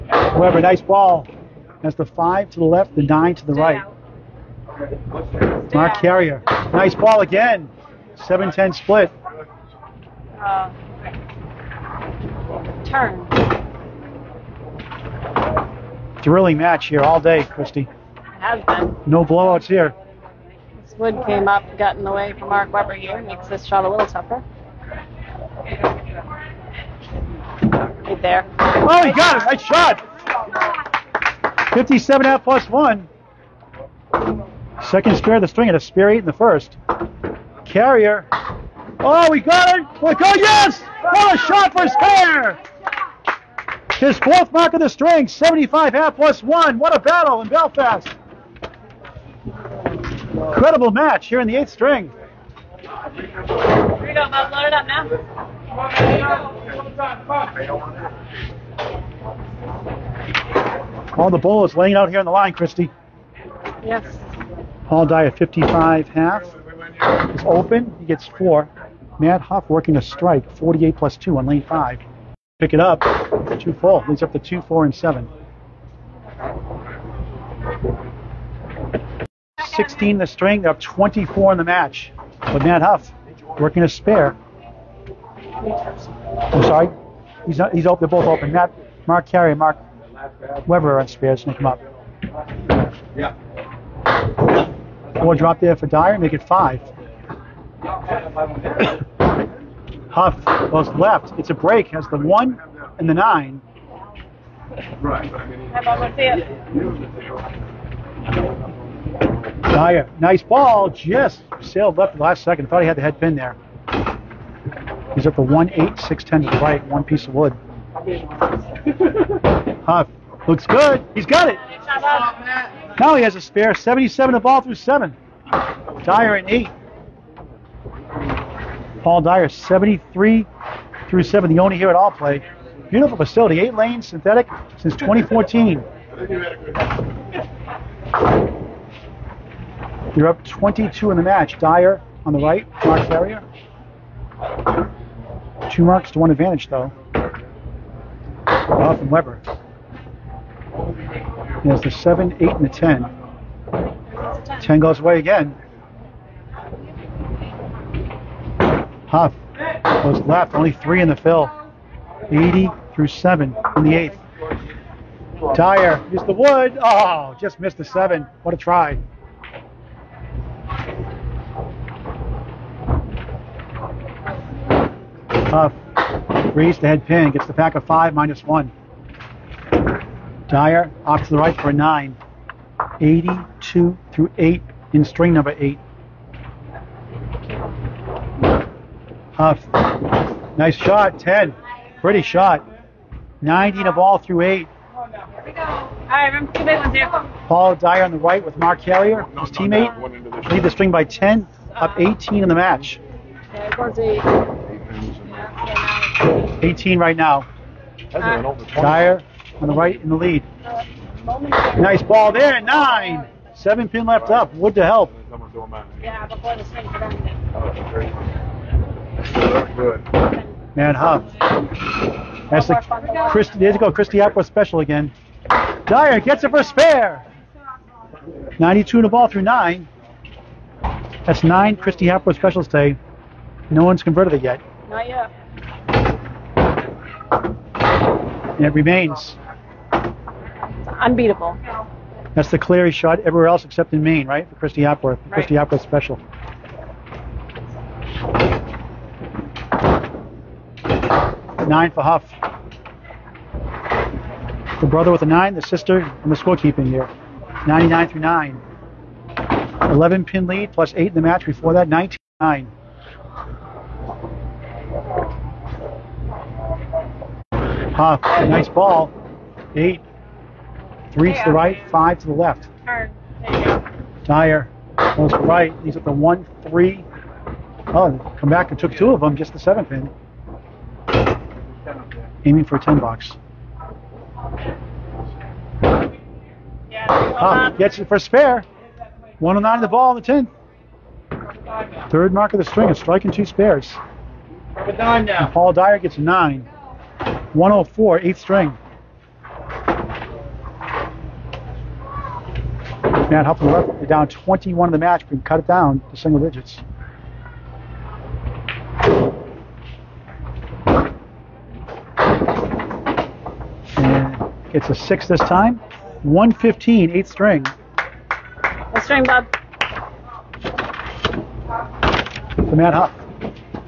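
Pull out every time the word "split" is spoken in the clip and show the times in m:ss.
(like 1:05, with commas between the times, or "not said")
0:08.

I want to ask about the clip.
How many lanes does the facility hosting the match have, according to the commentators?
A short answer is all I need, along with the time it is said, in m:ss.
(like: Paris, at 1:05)
8, at 2:13.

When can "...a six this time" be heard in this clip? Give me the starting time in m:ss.
5:14.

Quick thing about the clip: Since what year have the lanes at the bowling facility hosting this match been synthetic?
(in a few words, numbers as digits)
2014.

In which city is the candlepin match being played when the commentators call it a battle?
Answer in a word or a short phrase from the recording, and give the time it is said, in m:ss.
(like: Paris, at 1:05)
Belfast, at 0:47.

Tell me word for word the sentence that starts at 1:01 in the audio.
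All the bowl is laying out here on the line, Christy.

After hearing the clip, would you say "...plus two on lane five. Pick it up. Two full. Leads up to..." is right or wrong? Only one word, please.
right.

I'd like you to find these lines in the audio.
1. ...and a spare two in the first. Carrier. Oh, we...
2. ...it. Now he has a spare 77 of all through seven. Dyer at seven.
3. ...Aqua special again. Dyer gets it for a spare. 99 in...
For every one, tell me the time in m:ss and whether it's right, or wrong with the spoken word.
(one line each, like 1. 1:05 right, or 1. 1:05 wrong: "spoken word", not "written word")
1. 0:35 wrong: "eight", not "two"
2. 2:01 wrong: "eight", not "seven"
3. 3:44 wrong: "92", not "99".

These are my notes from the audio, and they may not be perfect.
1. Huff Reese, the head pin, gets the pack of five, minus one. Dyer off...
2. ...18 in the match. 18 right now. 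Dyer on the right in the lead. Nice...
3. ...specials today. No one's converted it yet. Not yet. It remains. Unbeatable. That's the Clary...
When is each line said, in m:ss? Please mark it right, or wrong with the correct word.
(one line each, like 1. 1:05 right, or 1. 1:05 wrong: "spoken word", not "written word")
1. 2:55 right
2. 3:21 right
3. 3:52 right.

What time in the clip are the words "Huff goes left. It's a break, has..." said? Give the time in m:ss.
1:40.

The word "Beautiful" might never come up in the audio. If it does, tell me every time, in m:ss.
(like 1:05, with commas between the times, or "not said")
2:12.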